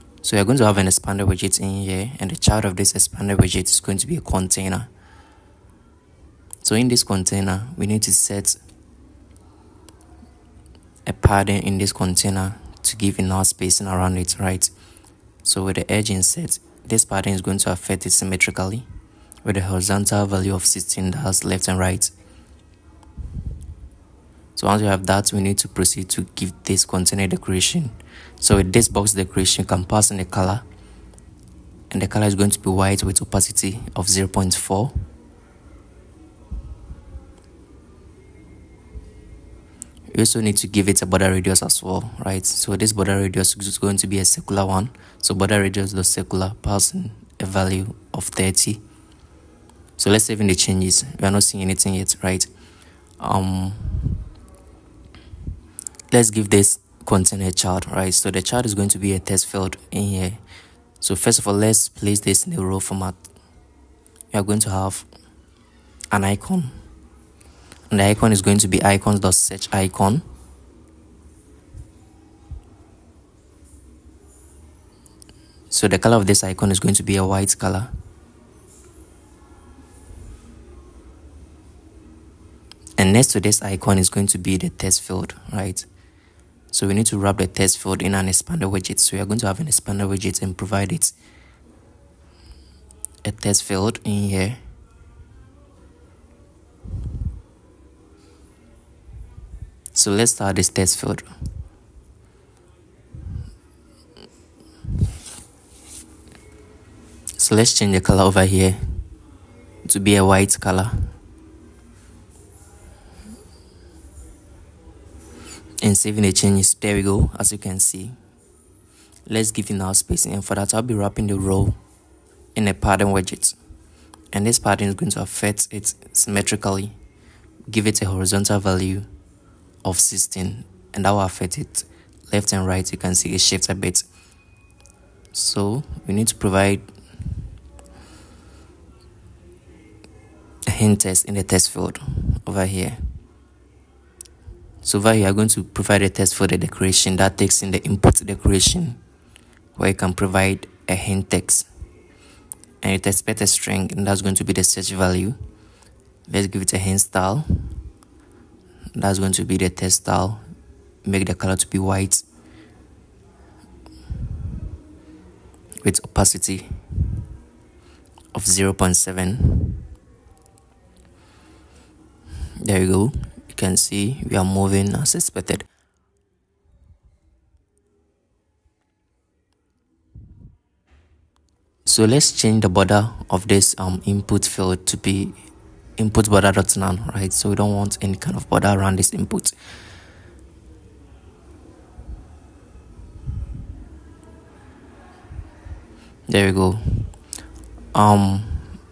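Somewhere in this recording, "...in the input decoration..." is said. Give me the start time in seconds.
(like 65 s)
147 s.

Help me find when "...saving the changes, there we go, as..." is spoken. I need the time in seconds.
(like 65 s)
115 s.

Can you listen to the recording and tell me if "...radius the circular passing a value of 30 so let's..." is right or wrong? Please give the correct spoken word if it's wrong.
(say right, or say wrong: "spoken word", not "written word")
right.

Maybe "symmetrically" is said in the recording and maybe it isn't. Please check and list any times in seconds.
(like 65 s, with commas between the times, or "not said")
18 s, 126 s.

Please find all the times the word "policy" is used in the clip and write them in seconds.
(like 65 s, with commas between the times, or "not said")
not said.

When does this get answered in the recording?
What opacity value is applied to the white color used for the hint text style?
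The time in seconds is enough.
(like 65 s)
168 s.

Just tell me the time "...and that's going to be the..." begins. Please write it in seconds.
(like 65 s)
153 s.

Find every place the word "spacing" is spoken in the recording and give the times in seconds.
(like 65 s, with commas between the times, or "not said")
13 s, 119 s.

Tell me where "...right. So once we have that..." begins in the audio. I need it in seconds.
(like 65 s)
21 s.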